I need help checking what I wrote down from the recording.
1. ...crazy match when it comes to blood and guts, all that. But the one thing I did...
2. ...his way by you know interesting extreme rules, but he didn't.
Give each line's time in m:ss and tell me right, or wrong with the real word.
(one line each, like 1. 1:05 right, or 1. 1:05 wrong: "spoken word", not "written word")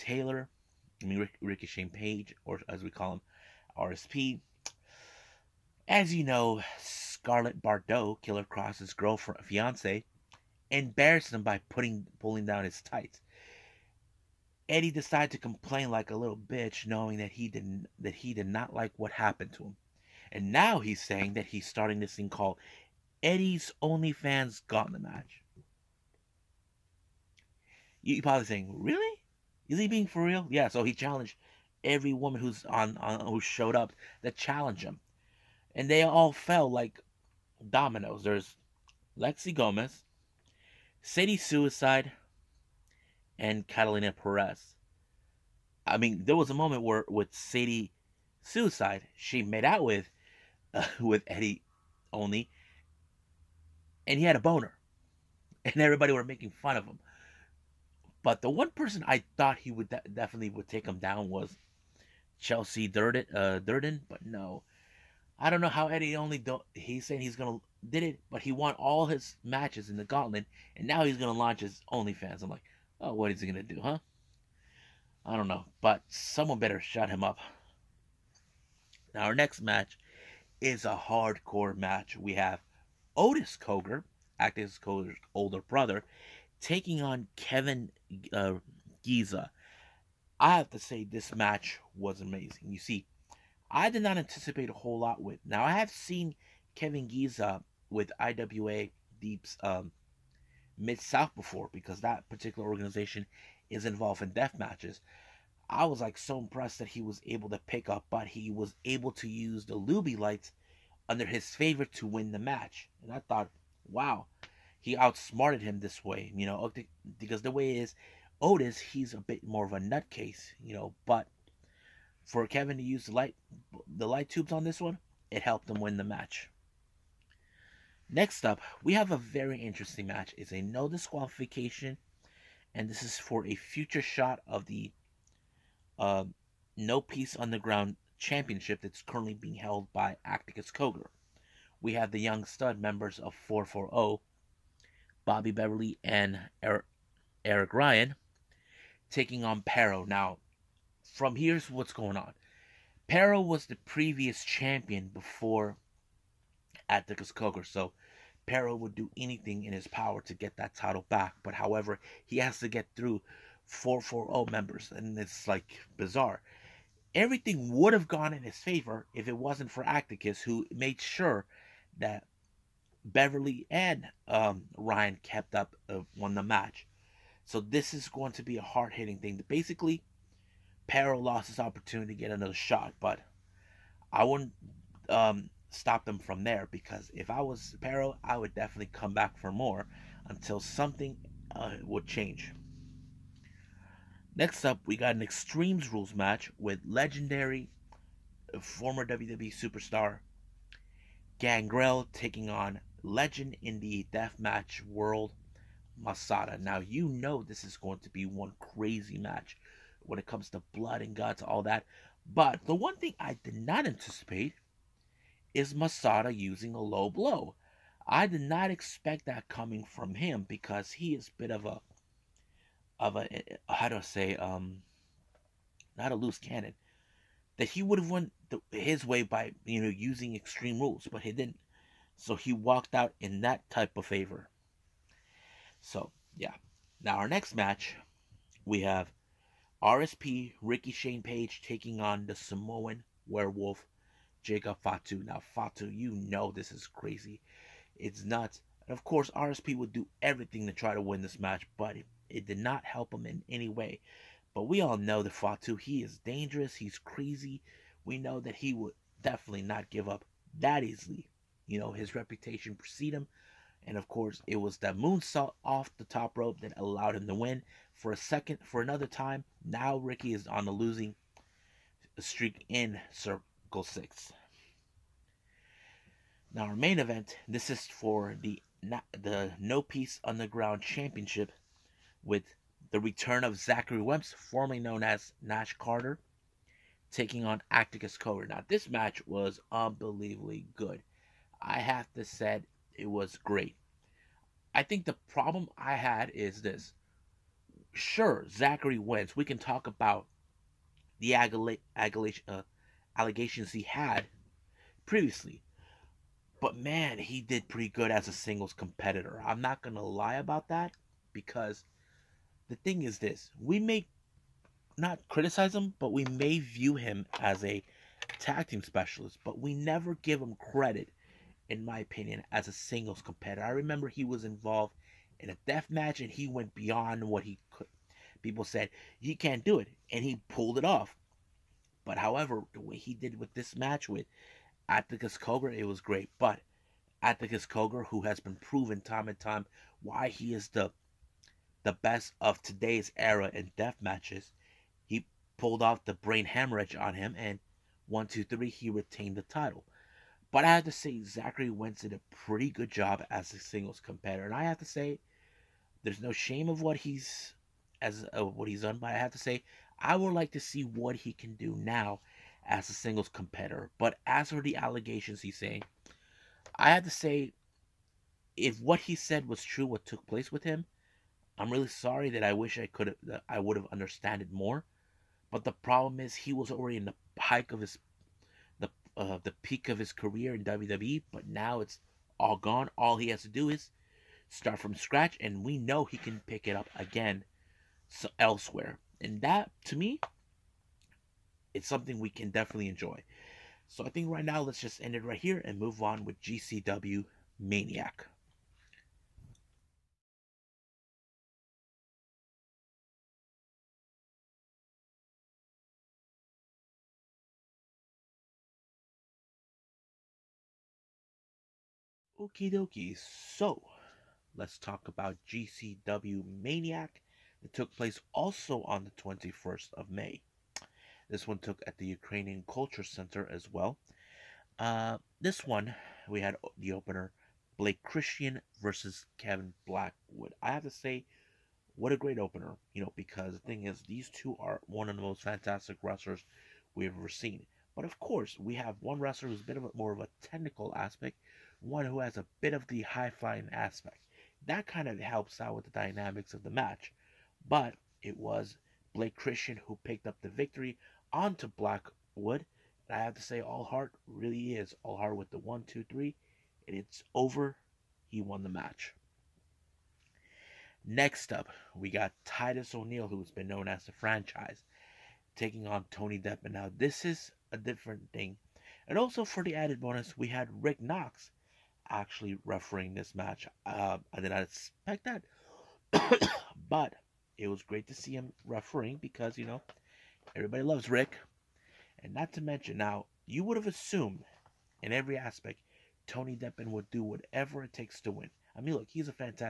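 1. 3:28 right
2. 3:48 wrong: "using", not "interesting".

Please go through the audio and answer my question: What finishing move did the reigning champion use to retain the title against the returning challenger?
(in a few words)
brain hemorrhage.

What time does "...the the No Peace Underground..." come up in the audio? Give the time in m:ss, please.
4:38.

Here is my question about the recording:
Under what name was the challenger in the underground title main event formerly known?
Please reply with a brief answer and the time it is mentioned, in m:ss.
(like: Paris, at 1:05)
Nash Carter, at 4:45.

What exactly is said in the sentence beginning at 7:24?
That kind of helps out with the dynamics of the match.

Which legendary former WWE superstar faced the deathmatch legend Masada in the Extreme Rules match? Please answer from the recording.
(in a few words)
Gangrel.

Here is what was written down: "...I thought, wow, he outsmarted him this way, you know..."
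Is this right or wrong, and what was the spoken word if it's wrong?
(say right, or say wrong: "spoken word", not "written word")
right.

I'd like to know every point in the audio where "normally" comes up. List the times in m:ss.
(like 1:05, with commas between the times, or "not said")
not said.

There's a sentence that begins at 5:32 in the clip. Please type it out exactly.
But however, the way he did with this match with Atticus Cogar, it was great.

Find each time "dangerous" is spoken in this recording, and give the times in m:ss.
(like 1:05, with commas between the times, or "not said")
4:16.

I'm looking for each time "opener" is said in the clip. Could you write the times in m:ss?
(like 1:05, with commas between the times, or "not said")
7:06, 7:12.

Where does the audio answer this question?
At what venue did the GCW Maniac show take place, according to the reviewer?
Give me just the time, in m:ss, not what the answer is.
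7:02.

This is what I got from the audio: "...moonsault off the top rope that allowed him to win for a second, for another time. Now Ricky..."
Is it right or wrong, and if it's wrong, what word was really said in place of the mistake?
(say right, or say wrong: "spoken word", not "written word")
right.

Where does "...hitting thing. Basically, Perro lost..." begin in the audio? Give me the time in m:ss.
2:58.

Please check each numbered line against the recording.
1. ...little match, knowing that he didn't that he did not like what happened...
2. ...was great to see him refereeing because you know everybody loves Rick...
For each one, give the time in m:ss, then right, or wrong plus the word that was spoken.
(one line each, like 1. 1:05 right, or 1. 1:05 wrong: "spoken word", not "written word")
1. 0:16 wrong: "bitch", not "match"
2. 7:57 right.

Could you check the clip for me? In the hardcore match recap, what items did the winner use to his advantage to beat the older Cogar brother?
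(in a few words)
light tubes.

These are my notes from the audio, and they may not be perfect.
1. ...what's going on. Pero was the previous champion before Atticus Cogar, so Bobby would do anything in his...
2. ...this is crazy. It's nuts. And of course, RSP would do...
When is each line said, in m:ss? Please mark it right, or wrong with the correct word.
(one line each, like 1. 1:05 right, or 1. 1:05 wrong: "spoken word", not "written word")
1. 2:31 wrong: "Pero", not "Bobby"
2. 4:06 right.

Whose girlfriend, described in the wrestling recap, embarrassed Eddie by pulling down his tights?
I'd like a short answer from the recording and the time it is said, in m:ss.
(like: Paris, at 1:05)
Killer Kross, at 0:08.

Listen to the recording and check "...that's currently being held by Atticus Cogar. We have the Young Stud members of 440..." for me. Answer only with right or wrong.
right.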